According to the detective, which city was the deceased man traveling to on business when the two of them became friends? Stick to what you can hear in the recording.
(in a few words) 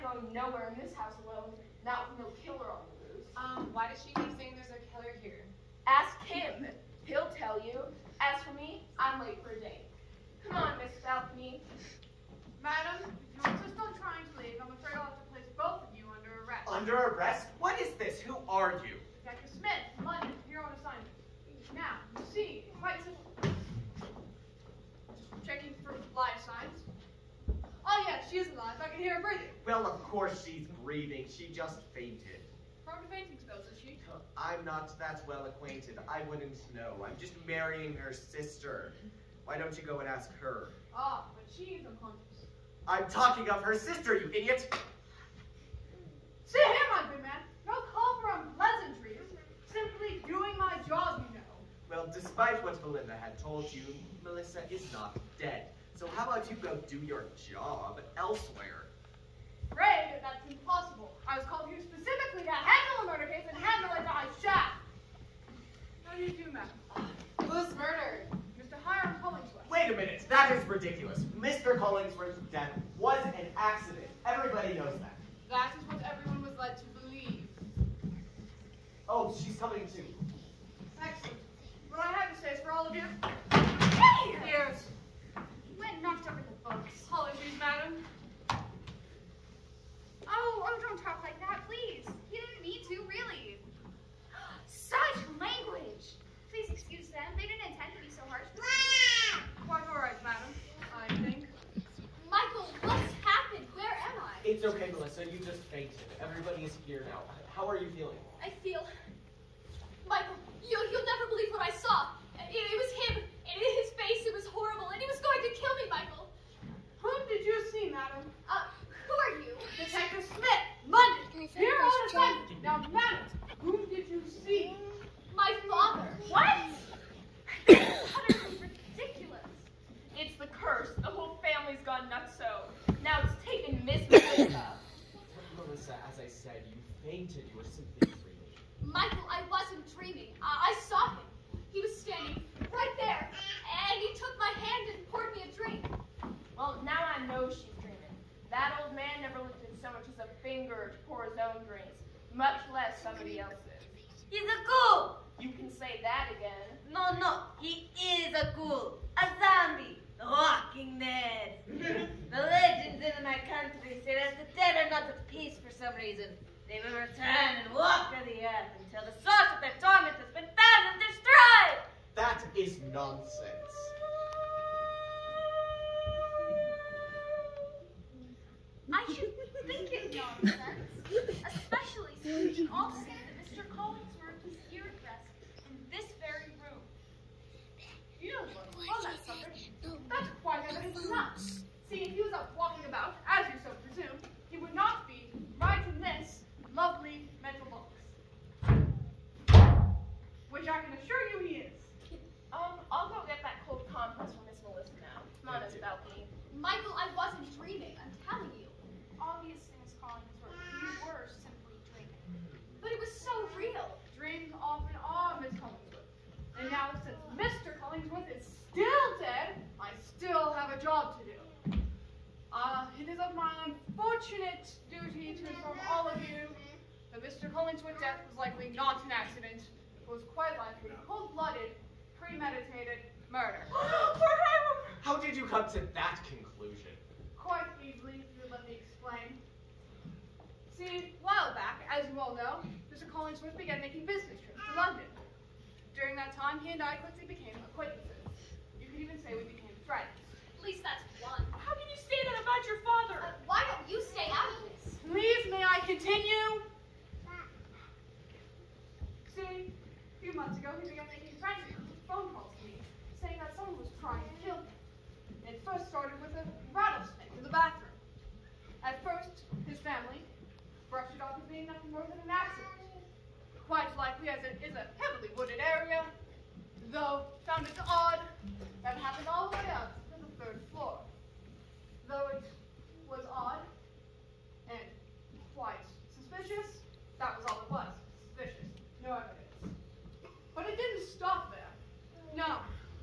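London.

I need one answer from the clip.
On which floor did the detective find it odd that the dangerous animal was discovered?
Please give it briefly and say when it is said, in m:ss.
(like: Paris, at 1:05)
Third floor, at 4:40.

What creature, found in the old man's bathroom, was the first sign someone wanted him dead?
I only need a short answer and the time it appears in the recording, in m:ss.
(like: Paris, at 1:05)
Rattlesnake, at 4:26.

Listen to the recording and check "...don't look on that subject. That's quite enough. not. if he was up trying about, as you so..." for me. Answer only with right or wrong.
wrong.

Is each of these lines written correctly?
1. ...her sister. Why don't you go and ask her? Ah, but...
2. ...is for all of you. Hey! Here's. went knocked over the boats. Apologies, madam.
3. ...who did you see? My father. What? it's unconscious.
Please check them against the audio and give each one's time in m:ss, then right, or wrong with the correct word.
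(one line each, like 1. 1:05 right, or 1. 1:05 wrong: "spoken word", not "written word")
1. 0:37 right
2. 1:22 right
3. 2:03 wrong: "ridiculous", not "unconscious".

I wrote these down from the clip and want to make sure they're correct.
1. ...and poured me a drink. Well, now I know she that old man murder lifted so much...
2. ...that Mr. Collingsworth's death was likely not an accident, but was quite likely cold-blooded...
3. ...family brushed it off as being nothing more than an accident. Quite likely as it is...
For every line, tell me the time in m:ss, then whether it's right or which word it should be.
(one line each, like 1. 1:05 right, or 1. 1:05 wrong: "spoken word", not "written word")
1. 2:24 wrong: "never", not "murder"
2. 3:47 right
3. 4:29 right.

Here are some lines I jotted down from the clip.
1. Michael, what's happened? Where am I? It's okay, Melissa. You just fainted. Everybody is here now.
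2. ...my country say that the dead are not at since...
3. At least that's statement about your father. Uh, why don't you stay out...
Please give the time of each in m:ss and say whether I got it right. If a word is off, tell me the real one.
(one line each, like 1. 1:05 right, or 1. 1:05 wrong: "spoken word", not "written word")
1. 1:42 right
2. 2:43 wrong: "peace", not "since"
3. 4:10 right.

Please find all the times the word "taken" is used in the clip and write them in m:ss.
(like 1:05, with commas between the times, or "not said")
2:13.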